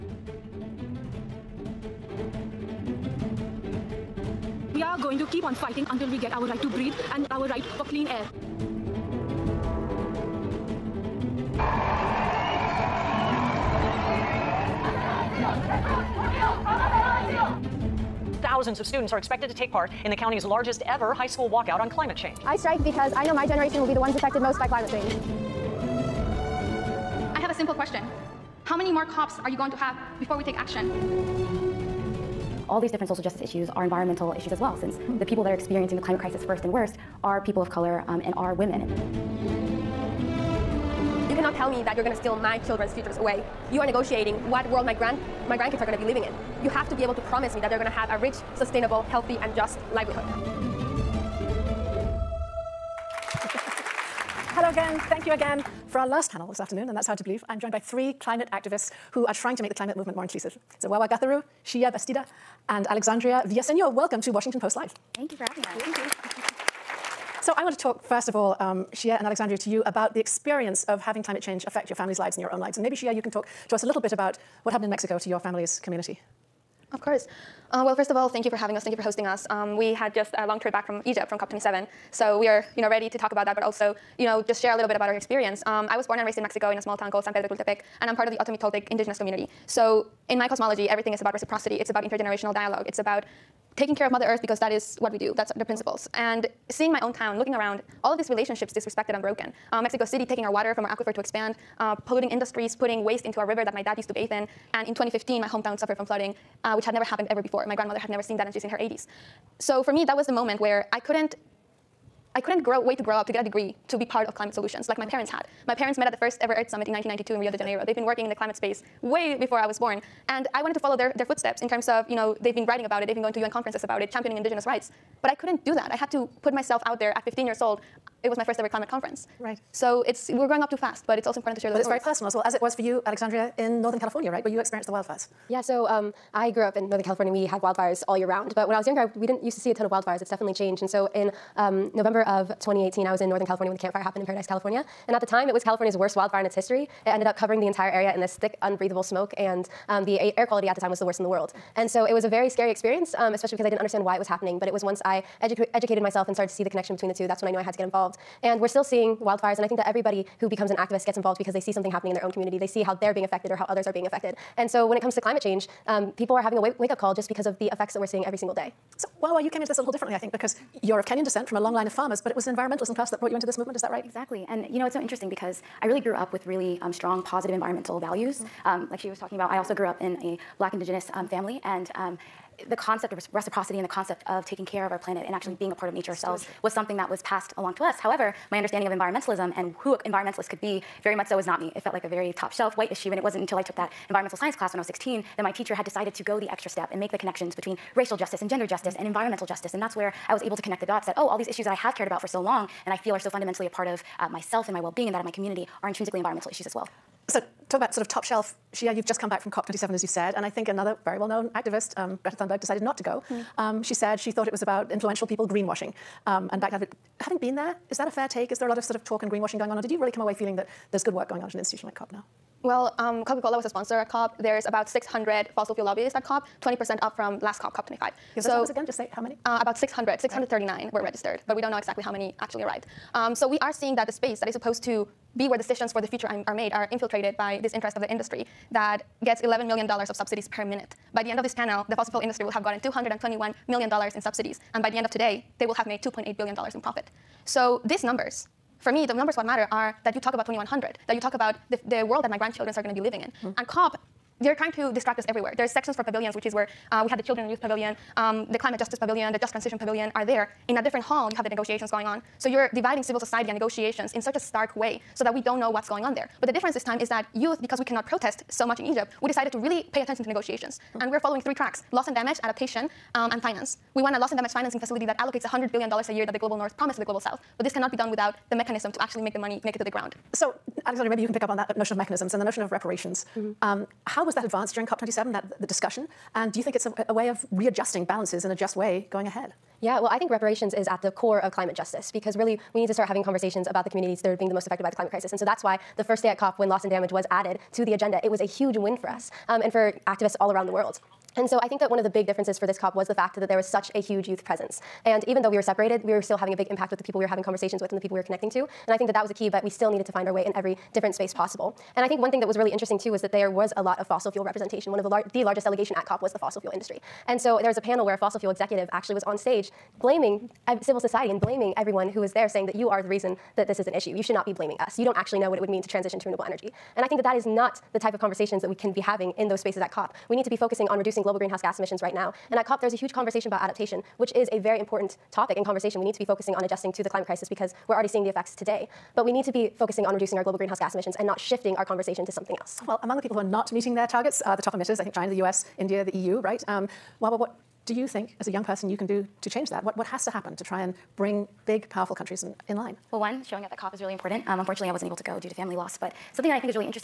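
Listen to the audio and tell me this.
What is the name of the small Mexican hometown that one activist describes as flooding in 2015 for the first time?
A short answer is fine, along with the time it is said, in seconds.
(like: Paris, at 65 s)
San Pedro Tultepec, at 87 s.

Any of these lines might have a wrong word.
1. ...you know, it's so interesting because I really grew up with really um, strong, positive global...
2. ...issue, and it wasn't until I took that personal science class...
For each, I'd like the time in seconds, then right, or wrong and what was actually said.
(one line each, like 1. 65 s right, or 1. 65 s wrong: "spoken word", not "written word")
1. 174 s wrong: "environmental", not "global"
2. 192 s wrong: "environmental", not "personal".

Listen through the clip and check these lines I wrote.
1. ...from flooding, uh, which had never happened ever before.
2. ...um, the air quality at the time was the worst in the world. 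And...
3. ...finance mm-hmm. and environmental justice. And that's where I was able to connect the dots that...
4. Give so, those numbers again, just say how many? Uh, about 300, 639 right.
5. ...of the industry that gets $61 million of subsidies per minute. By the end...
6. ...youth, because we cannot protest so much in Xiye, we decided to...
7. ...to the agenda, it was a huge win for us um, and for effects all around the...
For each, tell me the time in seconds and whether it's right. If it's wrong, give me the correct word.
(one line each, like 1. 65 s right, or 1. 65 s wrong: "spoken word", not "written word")
1. 105 s right
2. 149 s right
3. 198 s wrong: "justice", not "finance"
4. 228 s wrong: "600", not "300"
5. 237 s wrong: "11", not "61"
6. 267 s wrong: "Egypt", not "Xiye"
7. 297 s wrong: "activists", not "effects".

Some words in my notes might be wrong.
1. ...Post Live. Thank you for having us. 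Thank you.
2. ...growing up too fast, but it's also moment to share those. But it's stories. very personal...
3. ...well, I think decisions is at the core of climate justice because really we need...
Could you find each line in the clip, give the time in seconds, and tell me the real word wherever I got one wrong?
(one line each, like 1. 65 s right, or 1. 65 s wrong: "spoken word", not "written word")
1. 64 s right
2. 130 s wrong: "important", not "moment"
3. 289 s wrong: "reparations", not "decisions".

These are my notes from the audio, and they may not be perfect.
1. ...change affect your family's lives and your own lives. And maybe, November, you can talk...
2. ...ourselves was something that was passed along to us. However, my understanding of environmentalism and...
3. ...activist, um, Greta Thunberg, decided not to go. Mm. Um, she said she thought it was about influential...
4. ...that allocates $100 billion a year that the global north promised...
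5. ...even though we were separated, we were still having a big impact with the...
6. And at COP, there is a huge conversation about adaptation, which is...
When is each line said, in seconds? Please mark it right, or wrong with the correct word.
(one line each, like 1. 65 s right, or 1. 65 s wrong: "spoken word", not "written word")
1. 71 s wrong: "Xiye", not "November"
2. 186 s right
3. 211 s right
4. 275 s right
5. 305 s right
6. 332 s right.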